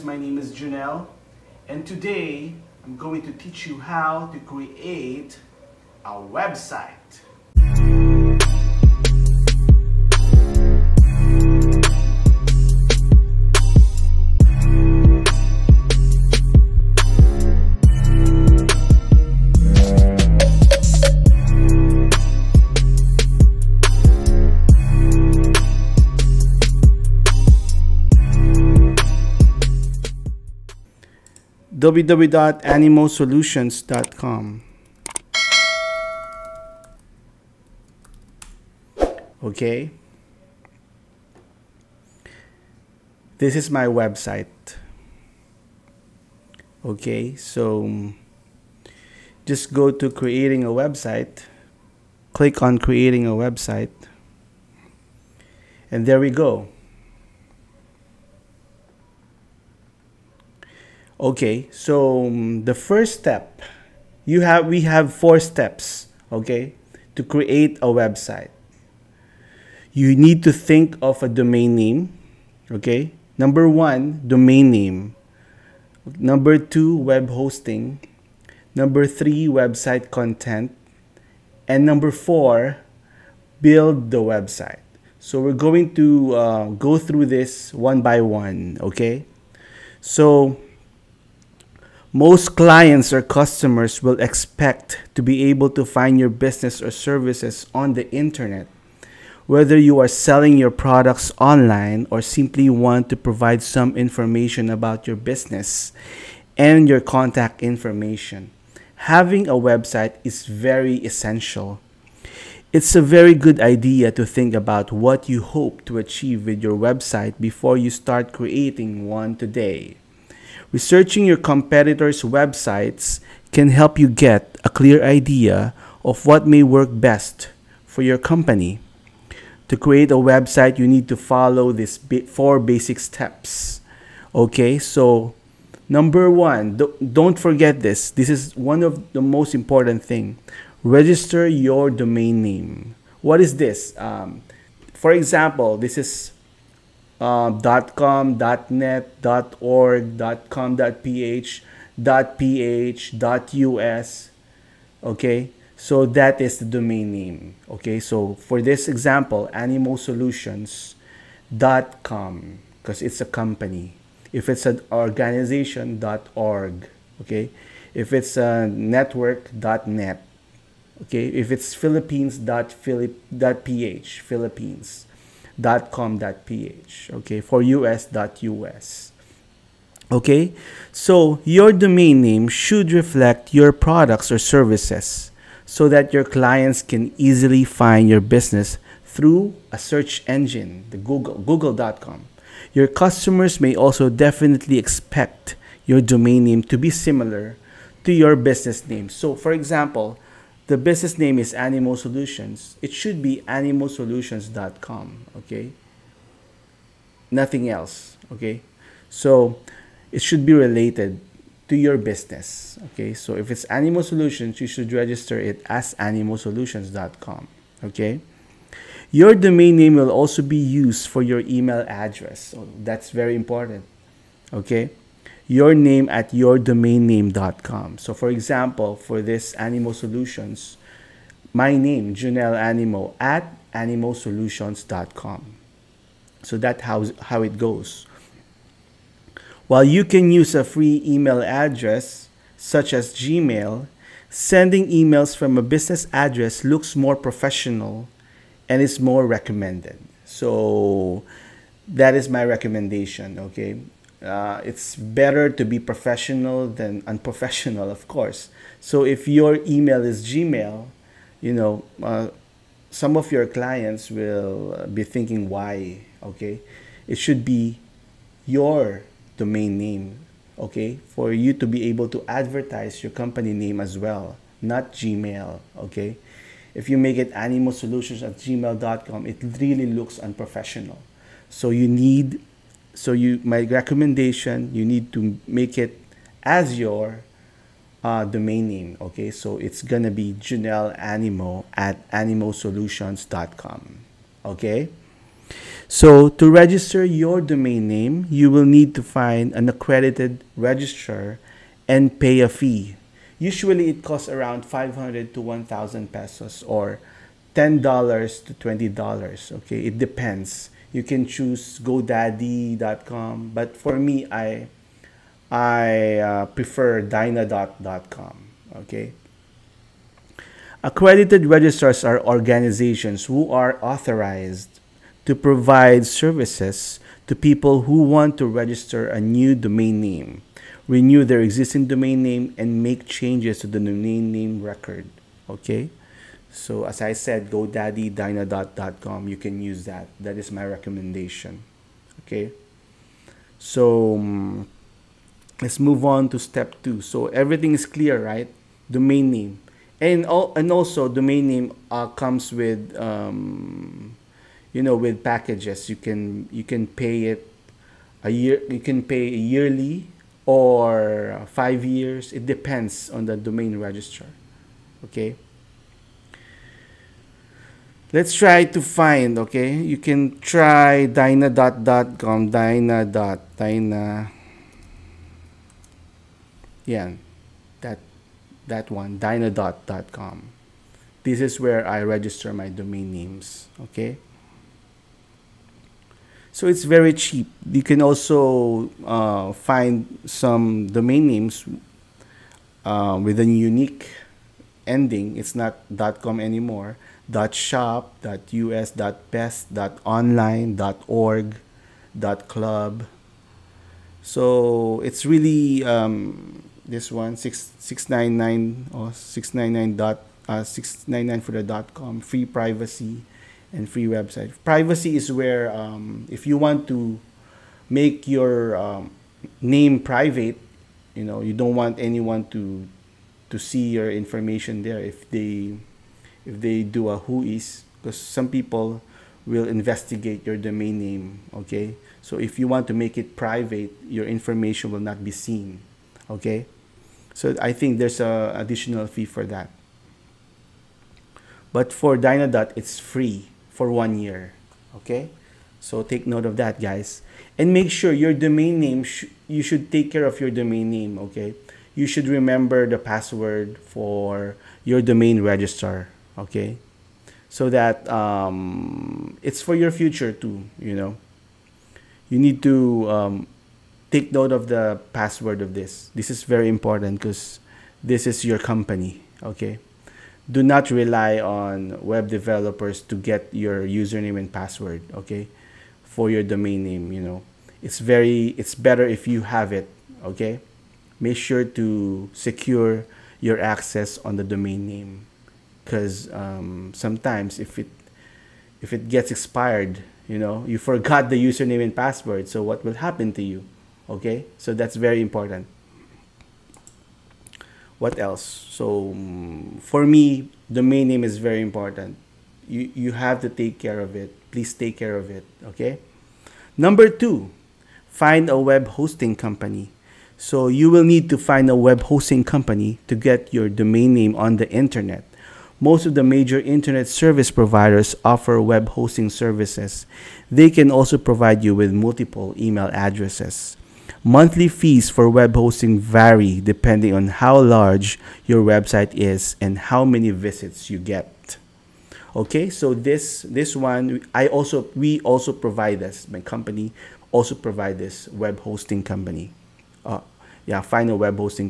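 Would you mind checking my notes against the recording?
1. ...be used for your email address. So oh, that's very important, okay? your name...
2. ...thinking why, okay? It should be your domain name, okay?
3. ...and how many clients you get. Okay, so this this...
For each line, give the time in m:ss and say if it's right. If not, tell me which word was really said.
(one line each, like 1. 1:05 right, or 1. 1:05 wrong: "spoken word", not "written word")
1. 3:40 right
2. 4:25 right
3. 8:49 wrong: "visits", not "clients".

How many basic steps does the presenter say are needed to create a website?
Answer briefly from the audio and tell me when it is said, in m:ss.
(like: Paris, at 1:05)
4, at 1:05.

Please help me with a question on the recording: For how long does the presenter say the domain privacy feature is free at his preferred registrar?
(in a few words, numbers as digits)
1 year.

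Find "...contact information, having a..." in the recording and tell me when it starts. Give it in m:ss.
1:47.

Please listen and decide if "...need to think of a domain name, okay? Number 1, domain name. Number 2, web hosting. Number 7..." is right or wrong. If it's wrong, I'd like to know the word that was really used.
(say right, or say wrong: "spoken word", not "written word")
wrong: "3", not "7".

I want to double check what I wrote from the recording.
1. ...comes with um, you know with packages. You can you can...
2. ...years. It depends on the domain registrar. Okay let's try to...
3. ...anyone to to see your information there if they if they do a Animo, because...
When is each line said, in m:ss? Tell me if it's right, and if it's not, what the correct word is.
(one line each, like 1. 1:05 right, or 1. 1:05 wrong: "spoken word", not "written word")
1. 5:52 right
2. 6:01 right
3. 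7:01 wrong: "WHOIS", not "Animo".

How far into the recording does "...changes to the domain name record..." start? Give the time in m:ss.
5:33.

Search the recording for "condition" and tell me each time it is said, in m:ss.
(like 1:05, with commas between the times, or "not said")
not said.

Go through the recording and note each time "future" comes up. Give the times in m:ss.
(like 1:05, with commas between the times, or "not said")
7:39.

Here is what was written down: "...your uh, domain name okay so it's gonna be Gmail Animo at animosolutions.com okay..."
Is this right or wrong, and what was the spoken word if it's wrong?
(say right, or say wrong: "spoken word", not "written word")
wrong: "Junnel", not "Gmail".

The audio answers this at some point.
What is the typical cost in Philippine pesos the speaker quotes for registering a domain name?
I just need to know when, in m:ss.
5:04.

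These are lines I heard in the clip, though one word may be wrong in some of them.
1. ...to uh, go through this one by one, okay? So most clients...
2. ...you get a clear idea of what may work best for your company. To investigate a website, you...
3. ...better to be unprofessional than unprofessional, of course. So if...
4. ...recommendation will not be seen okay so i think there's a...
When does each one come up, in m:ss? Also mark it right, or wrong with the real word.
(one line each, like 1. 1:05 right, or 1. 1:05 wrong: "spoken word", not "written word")
1. 1:25 right
2. 2:04 wrong: "create", not "investigate"
3. 4:14 wrong: "professional", not "unprofessional"
4. 7:14 wrong: "information", not "recommendation".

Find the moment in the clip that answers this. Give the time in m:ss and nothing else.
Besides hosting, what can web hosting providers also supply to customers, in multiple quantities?
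8:42.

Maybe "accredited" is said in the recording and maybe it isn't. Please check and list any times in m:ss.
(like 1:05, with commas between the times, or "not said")
4:59, 5:20.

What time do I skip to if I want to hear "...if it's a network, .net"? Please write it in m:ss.
2:47.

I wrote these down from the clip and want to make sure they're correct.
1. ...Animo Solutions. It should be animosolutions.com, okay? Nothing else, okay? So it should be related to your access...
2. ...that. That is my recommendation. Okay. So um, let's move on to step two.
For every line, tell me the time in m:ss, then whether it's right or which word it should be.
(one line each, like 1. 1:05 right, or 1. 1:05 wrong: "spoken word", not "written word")
1. 3:21 wrong: "business", not "access"
2. 5:39 right.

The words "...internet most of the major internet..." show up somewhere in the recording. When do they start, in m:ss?
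8:34.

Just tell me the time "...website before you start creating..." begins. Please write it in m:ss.
1:56.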